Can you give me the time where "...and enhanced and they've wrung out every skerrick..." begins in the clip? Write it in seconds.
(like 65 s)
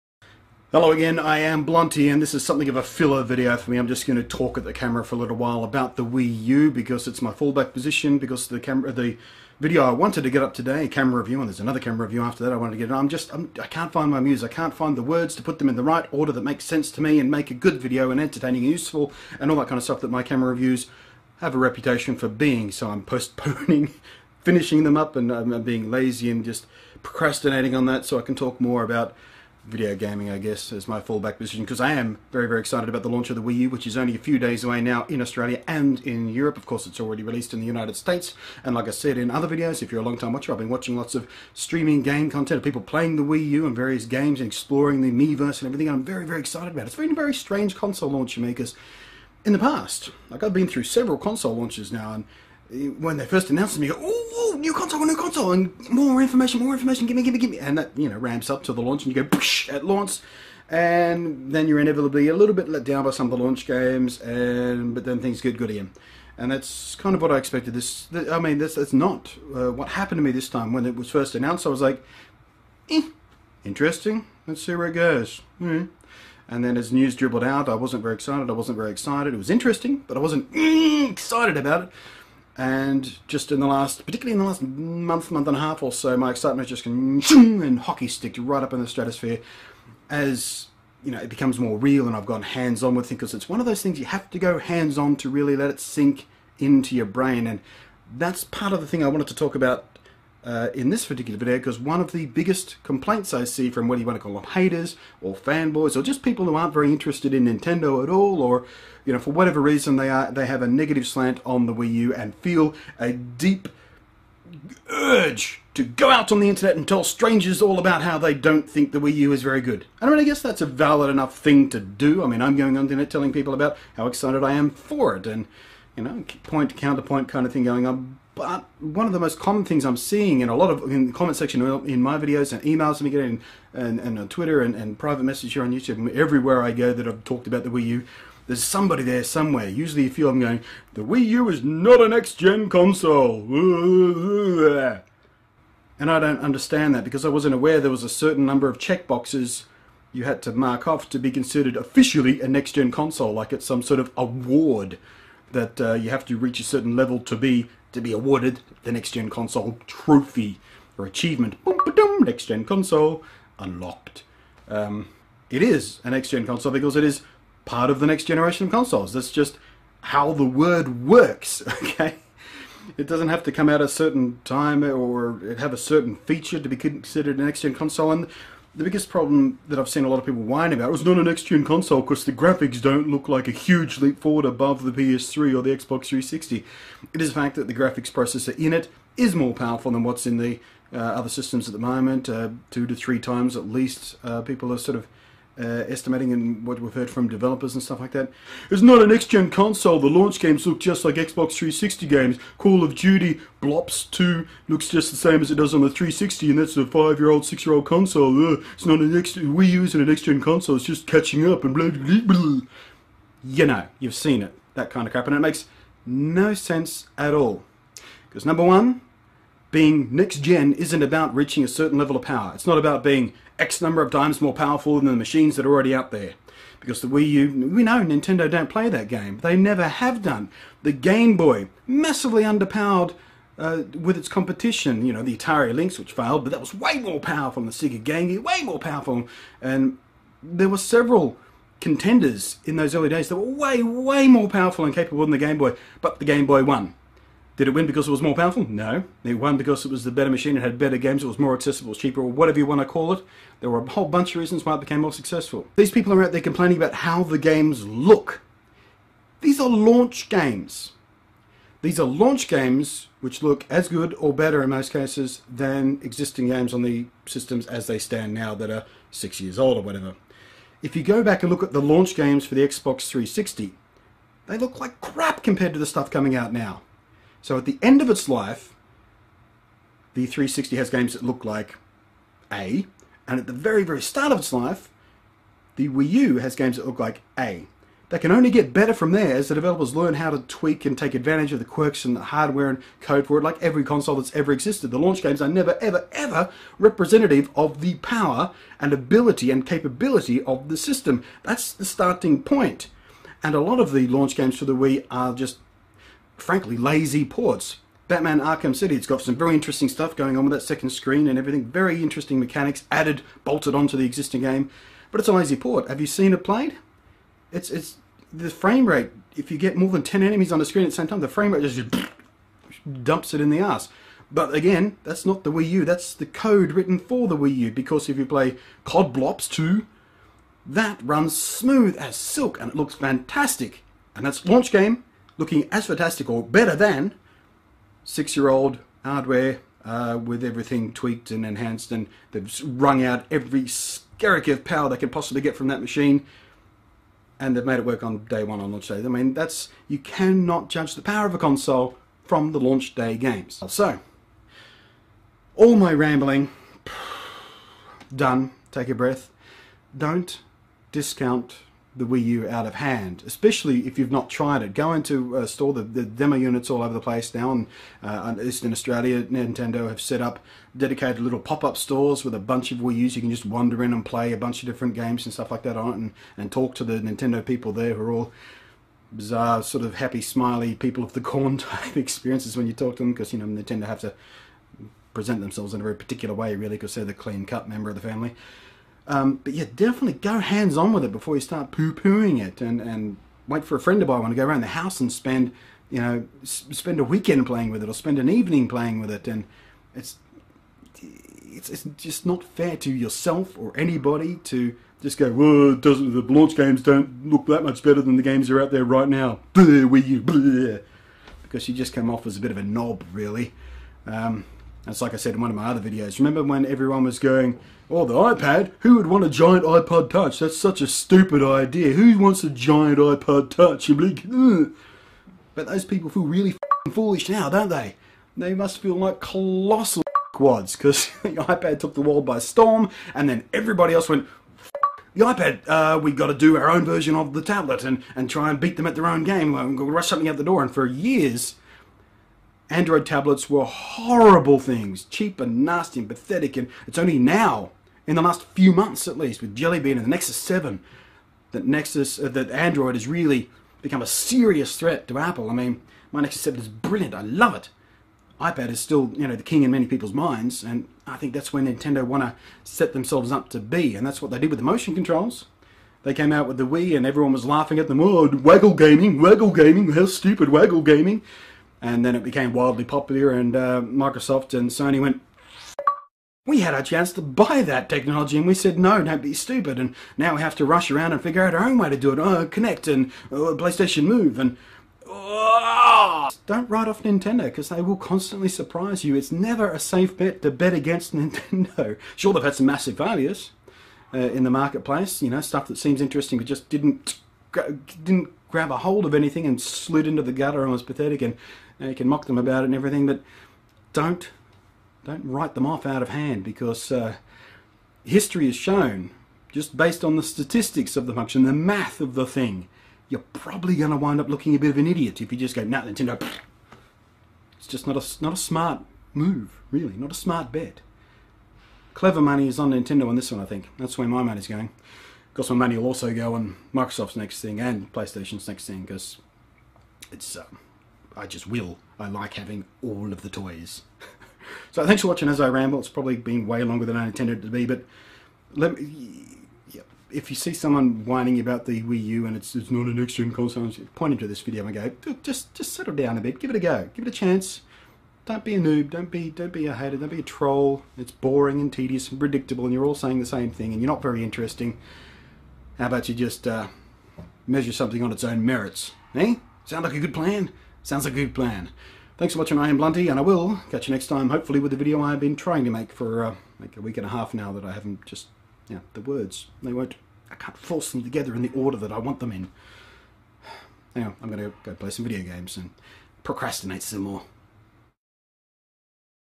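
341 s.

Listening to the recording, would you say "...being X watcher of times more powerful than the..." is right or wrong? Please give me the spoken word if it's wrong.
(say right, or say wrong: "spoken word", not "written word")
wrong: "number", not "watcher".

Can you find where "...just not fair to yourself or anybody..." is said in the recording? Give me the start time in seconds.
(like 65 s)
401 s.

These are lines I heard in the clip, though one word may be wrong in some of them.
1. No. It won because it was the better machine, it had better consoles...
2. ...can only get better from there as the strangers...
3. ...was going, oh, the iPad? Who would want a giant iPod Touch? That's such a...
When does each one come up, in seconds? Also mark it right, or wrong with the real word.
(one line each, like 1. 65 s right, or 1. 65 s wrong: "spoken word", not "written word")
1. 248 s wrong: "games", not "consoles"
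2. 288 s wrong: "developers", not "strangers"
3. 417 s right.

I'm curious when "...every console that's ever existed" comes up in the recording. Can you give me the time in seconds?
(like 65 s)
293 s.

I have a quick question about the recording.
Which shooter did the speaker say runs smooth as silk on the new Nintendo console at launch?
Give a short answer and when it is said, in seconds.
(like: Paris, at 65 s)
Call of Duty Black Ops 2, at 328 s.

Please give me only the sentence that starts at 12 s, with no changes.
I'm just, I'm, I can not find my muse.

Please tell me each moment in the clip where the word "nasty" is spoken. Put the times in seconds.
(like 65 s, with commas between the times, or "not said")
445 s.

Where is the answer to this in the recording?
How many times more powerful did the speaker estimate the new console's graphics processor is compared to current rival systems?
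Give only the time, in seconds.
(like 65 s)
192 s.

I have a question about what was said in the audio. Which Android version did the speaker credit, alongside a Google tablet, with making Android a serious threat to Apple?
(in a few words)
Jelly Bean.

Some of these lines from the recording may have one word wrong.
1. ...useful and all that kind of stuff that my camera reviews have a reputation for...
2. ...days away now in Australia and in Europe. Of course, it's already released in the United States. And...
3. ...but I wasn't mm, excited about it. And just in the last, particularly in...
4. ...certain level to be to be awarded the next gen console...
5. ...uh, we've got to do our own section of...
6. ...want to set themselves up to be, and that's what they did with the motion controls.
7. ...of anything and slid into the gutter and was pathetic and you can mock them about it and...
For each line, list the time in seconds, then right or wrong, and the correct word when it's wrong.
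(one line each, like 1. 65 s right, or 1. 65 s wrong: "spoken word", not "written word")
1. 18 s right
2. 34 s right
3. 80 s right
4. 156 s right
5. 435 s wrong: "version", not "section"
6. 462 s right
7. 499 s right.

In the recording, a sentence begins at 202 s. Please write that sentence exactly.
Call of Duty Blops 2 looks just the same as it does on the 360, and that's a five-year-old, six-year-old console.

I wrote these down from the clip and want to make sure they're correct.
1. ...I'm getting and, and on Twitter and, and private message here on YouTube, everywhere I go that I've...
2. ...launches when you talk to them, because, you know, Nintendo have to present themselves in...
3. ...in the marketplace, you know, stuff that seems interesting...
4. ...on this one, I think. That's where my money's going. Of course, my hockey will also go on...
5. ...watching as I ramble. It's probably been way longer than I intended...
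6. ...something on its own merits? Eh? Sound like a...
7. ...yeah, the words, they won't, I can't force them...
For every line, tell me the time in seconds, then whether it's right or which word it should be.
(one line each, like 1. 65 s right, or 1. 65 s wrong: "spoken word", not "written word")
1. 132 s right
2. 381 s wrong: "experiences", not "launches"
3. 494 s right
4. 523 s wrong: "money", not "hockey"
5. 535 s right
6. 557 s right
7. 568 s right.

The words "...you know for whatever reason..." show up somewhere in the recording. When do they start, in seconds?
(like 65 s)
109 s.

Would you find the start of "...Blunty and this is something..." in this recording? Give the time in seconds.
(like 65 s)
1 s.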